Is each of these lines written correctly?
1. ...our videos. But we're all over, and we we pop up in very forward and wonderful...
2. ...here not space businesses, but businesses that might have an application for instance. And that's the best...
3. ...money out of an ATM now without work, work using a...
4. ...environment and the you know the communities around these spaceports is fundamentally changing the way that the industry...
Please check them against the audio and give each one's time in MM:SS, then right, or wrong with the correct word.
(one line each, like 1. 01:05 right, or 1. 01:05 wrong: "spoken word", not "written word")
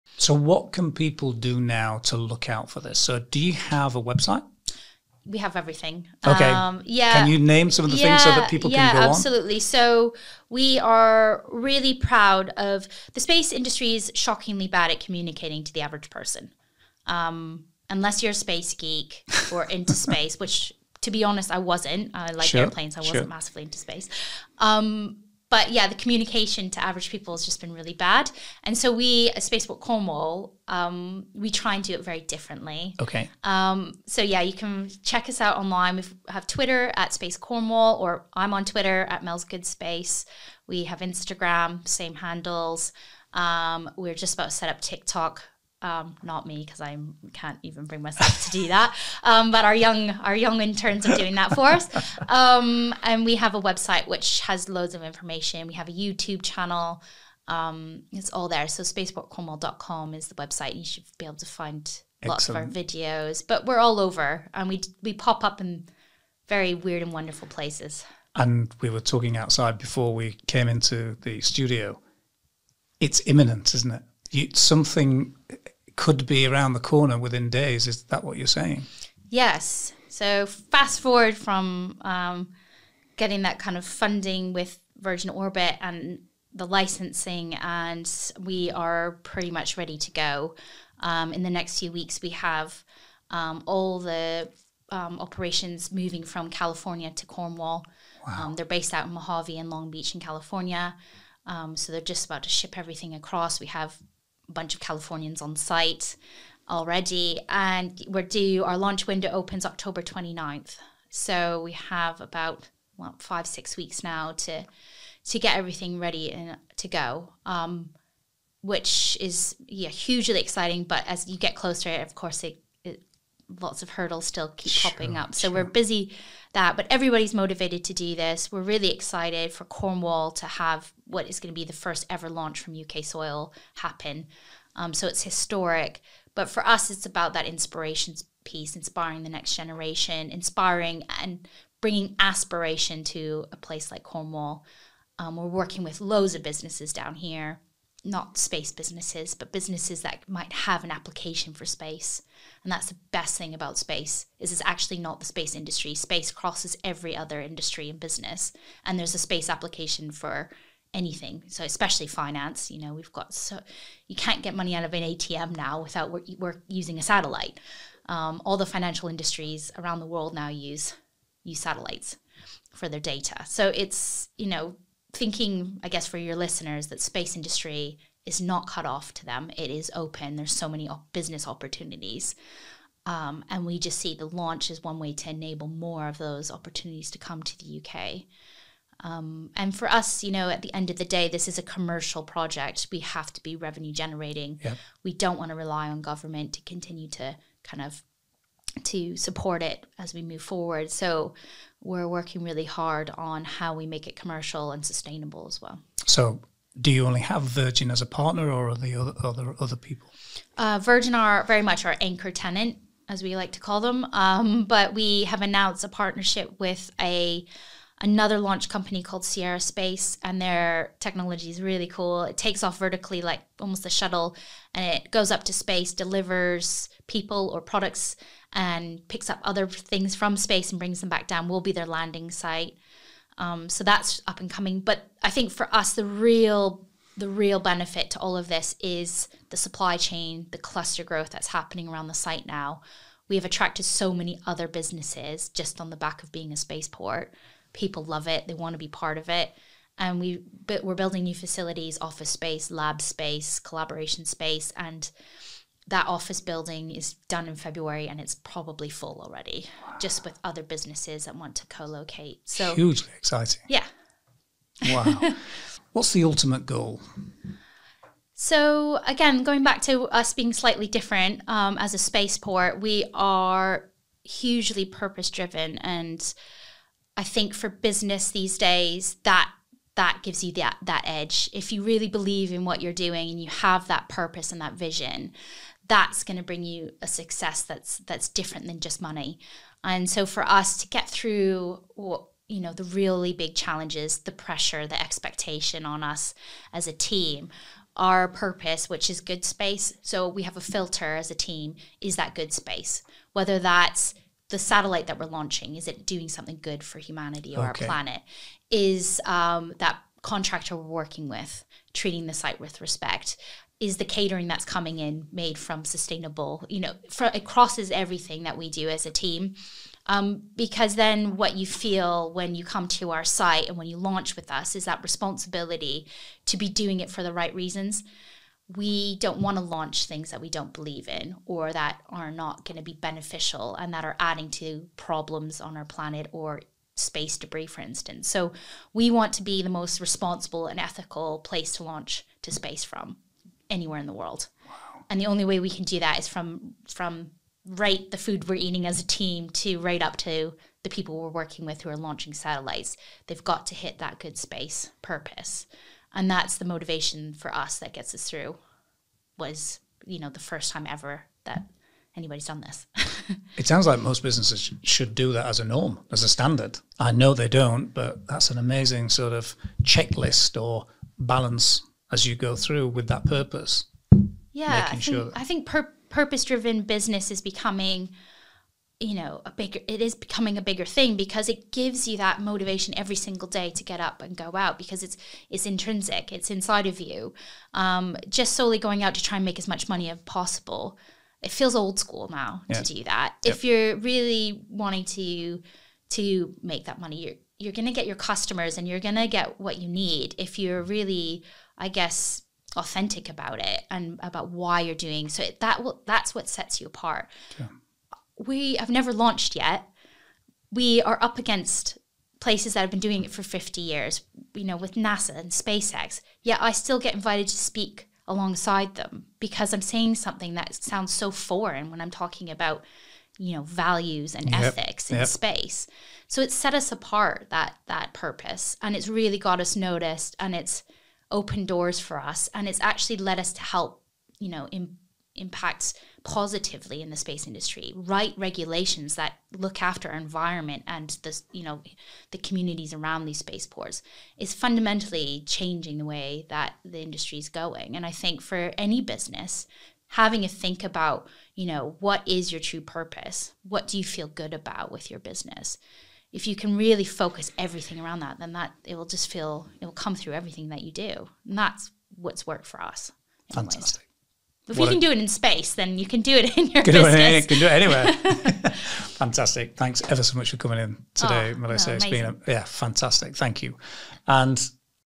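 1. 01:02 wrong: "weird", not "forward"
2. 02:27 wrong: "space", not "instance"
3. 02:44 right
4. 07:20 right.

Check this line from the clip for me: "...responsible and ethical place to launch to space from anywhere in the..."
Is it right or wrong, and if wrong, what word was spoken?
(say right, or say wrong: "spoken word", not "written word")
right.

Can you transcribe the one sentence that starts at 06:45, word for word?
So it, that will that's what sets you apart.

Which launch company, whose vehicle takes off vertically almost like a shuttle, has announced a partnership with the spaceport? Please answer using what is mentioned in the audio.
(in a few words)
Sierra Space.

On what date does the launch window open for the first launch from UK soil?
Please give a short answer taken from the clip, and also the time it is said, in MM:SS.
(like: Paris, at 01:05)
October 29, at 01:49.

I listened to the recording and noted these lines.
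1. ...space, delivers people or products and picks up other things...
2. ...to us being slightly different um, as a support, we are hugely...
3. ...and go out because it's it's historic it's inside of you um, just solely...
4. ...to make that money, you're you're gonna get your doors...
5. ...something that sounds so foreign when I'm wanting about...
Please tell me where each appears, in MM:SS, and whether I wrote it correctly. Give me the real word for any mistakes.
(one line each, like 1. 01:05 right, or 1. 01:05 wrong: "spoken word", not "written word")
1. 03:45 right
2. 04:29 wrong: "spaceport", not "support"
3. 06:24 wrong: "intrinsic", not "historic"
4. 06:36 wrong: "customers", not "doors"
5. 07:00 wrong: "talking", not "wanting".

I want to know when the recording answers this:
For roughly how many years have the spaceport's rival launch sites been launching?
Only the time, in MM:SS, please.
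06:53.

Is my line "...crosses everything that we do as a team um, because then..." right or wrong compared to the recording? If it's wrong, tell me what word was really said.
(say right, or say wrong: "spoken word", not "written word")
right.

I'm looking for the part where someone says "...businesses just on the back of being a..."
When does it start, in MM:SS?
04:04.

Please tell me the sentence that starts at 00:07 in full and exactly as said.
Can you name some of the yeah, things so that people yeah, can go absolutely.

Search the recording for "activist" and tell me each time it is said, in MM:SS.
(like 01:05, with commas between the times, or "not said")
not said.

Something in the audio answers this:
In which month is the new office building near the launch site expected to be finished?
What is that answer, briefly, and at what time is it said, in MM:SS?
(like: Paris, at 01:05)
February, at 04:17.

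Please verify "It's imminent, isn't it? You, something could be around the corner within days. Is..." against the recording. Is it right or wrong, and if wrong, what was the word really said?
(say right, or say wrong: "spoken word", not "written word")
right.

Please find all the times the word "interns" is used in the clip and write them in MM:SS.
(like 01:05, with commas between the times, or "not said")
00:50.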